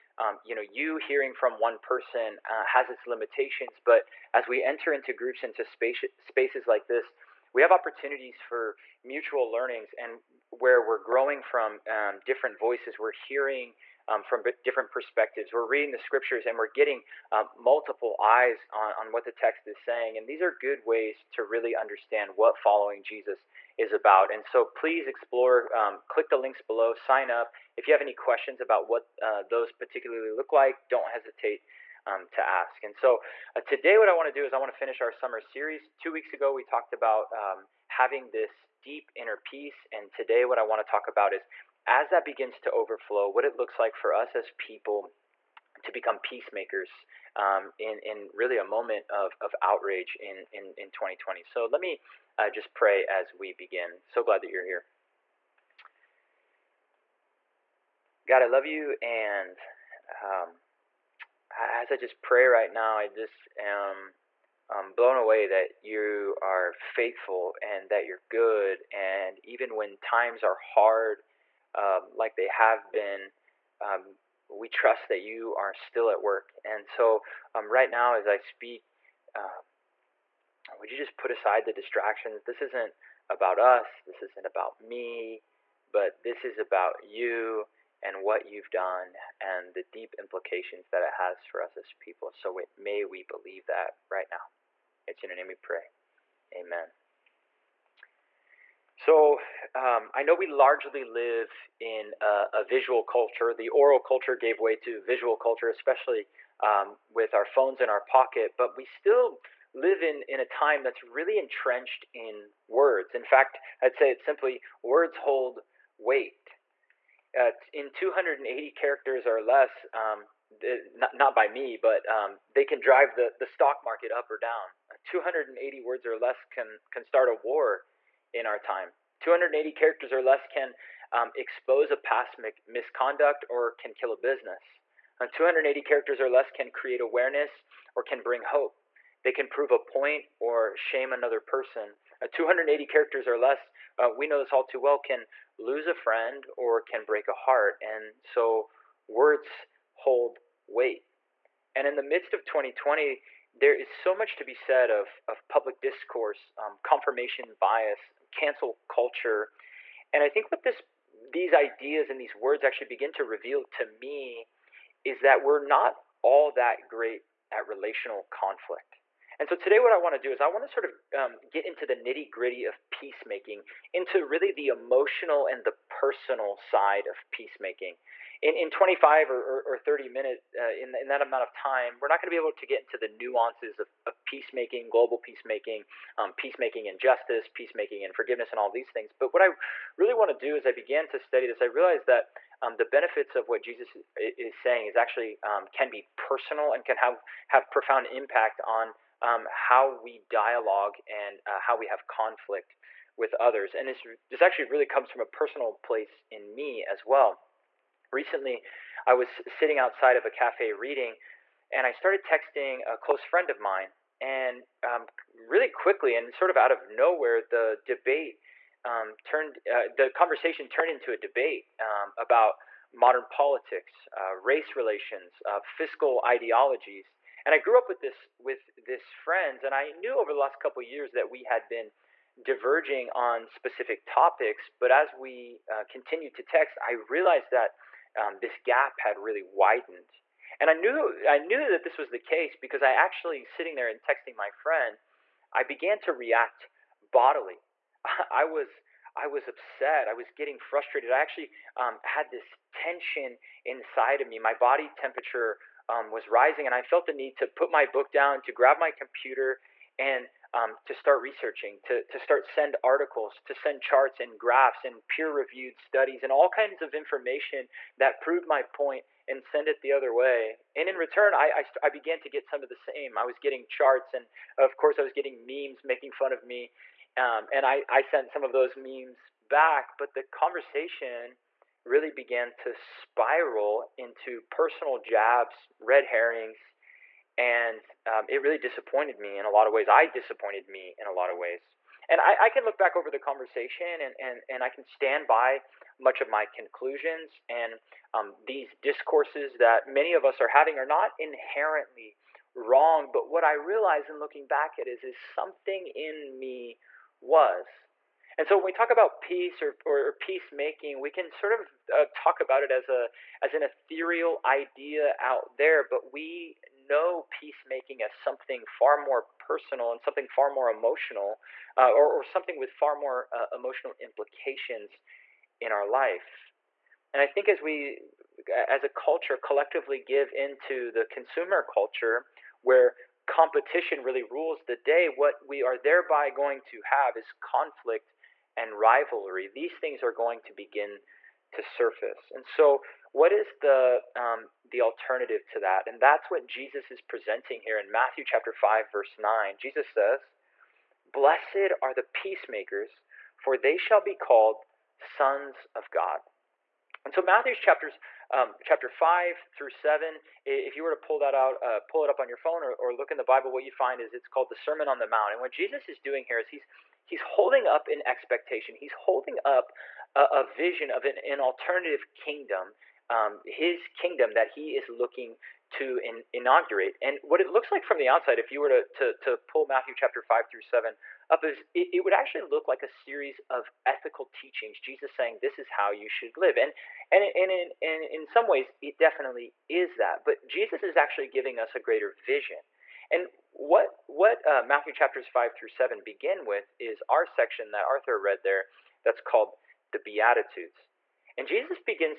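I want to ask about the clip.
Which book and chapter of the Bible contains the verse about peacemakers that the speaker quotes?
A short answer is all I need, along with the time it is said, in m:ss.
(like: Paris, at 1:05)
Matthew chapter 5, at 5:47.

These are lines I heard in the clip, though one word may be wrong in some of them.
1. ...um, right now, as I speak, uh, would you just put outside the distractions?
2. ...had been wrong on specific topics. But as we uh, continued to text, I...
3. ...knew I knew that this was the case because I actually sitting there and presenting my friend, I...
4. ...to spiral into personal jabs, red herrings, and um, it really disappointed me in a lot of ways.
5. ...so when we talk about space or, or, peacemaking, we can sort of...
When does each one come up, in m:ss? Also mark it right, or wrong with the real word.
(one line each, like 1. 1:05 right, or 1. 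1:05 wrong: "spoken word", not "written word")
1. 1:17 wrong: "aside", not "outside"
2. 3:51 wrong: "diverging", not "wrong"
3. 4:00 wrong: "texting", not "presenting"
4. 4:42 right
5. 5:08 wrong: "peace", not "space".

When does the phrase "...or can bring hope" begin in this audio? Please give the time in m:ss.
2:17.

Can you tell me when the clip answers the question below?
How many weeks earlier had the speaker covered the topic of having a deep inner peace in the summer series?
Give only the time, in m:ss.
0:35.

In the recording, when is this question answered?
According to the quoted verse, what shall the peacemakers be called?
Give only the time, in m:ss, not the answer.
5:54.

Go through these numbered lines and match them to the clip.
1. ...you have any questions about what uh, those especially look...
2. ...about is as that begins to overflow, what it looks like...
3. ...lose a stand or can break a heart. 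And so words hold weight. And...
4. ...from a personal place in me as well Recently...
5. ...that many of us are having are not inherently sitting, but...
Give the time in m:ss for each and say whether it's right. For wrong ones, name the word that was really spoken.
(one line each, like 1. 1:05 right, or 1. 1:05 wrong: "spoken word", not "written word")
1. 0:27 wrong: "particularly", not "especially"
2. 0:41 right
3. 2:25 wrong: "friend", not "stand"
4. 3:25 right
5. 4:59 wrong: "wrong", not "sitting".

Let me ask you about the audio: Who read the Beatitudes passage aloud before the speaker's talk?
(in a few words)
Arthur.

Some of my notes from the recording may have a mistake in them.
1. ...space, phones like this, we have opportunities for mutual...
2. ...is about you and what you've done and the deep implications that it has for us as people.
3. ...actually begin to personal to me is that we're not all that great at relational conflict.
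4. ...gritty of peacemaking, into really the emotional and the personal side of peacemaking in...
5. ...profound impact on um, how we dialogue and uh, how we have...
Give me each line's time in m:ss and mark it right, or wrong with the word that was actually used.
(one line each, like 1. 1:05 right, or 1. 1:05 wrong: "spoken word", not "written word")
1. 0:05 wrong: "spaces", not "phones"
2. 1:26 right
3. 2:42 wrong: "reveal", not "personal"
4. 2:52 right
5. 3:17 right.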